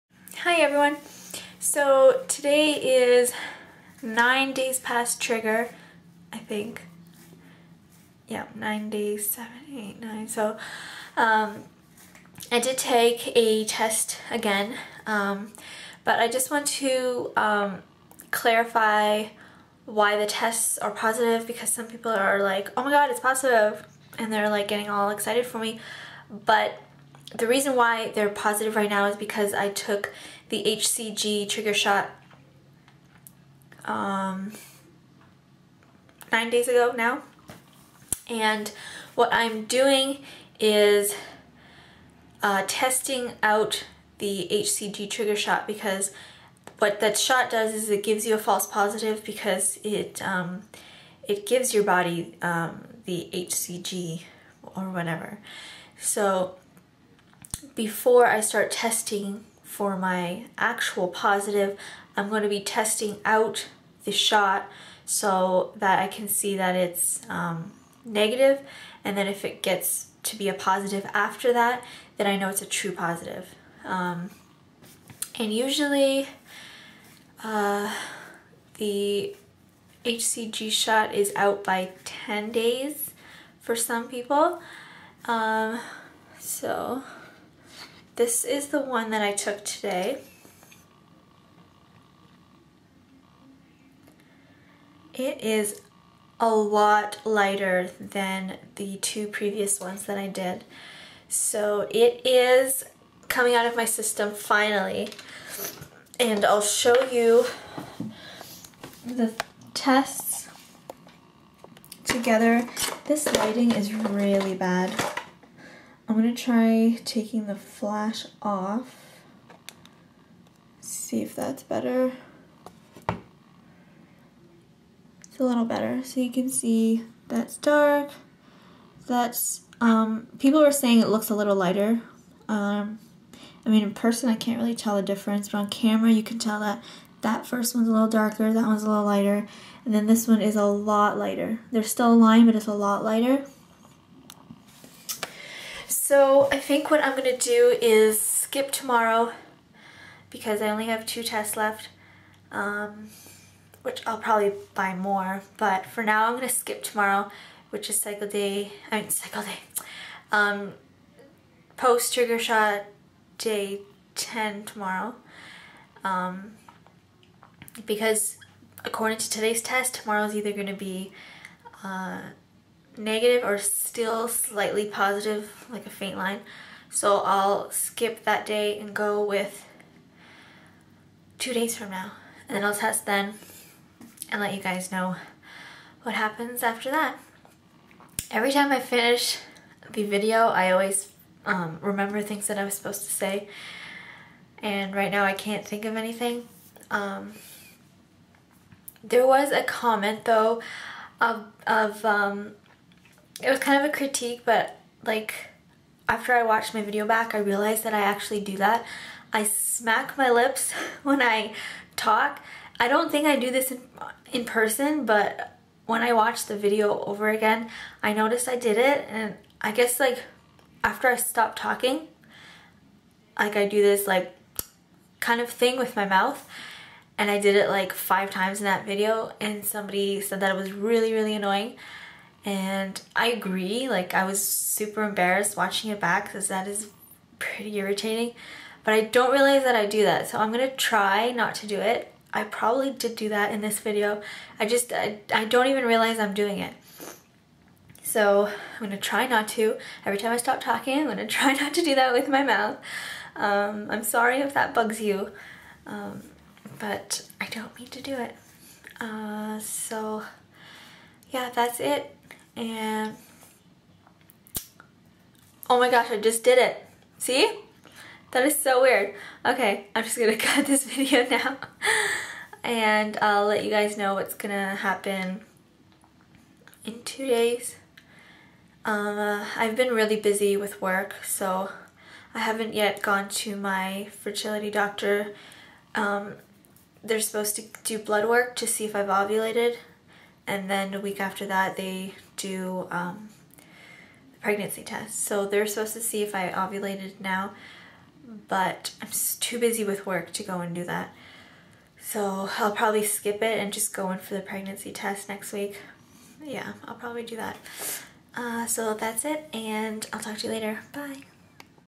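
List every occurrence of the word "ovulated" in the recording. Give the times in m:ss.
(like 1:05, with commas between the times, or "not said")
4:49, 4:56.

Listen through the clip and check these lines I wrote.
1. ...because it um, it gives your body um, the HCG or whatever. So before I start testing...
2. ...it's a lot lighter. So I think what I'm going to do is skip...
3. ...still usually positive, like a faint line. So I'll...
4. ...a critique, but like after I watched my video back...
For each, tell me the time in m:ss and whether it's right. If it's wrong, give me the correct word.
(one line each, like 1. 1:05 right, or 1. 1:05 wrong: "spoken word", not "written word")
1. 0:49 right
2. 2:22 right
3. 2:53 wrong: "slightly", not "usually"
4. 3:23 right.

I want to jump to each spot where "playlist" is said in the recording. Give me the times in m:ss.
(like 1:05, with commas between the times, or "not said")
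not said.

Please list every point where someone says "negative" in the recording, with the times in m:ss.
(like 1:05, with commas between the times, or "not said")
1:08, 2:52.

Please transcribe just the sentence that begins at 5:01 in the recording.
So I'll probably skip it and just go in for the pregnancy test next week.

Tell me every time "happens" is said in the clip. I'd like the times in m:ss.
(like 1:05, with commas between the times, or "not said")
3:06, 4:34.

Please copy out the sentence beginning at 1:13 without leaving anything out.
Um, and usually uh, the HCG shot is out by 10 days for some people.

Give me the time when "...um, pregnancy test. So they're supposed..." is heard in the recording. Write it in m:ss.
4:52.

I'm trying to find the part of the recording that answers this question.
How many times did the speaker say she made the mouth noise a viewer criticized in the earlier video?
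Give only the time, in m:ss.
3:47.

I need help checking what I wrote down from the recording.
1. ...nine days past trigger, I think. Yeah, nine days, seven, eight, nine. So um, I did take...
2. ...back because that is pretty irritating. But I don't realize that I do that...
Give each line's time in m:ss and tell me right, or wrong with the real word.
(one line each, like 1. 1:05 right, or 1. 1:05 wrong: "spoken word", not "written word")
1. 0:04 right
2. 3:55 right.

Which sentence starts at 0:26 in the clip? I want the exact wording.
But the reason why they're positive right now is because I took the HCG trigger shot um, nine days ago now.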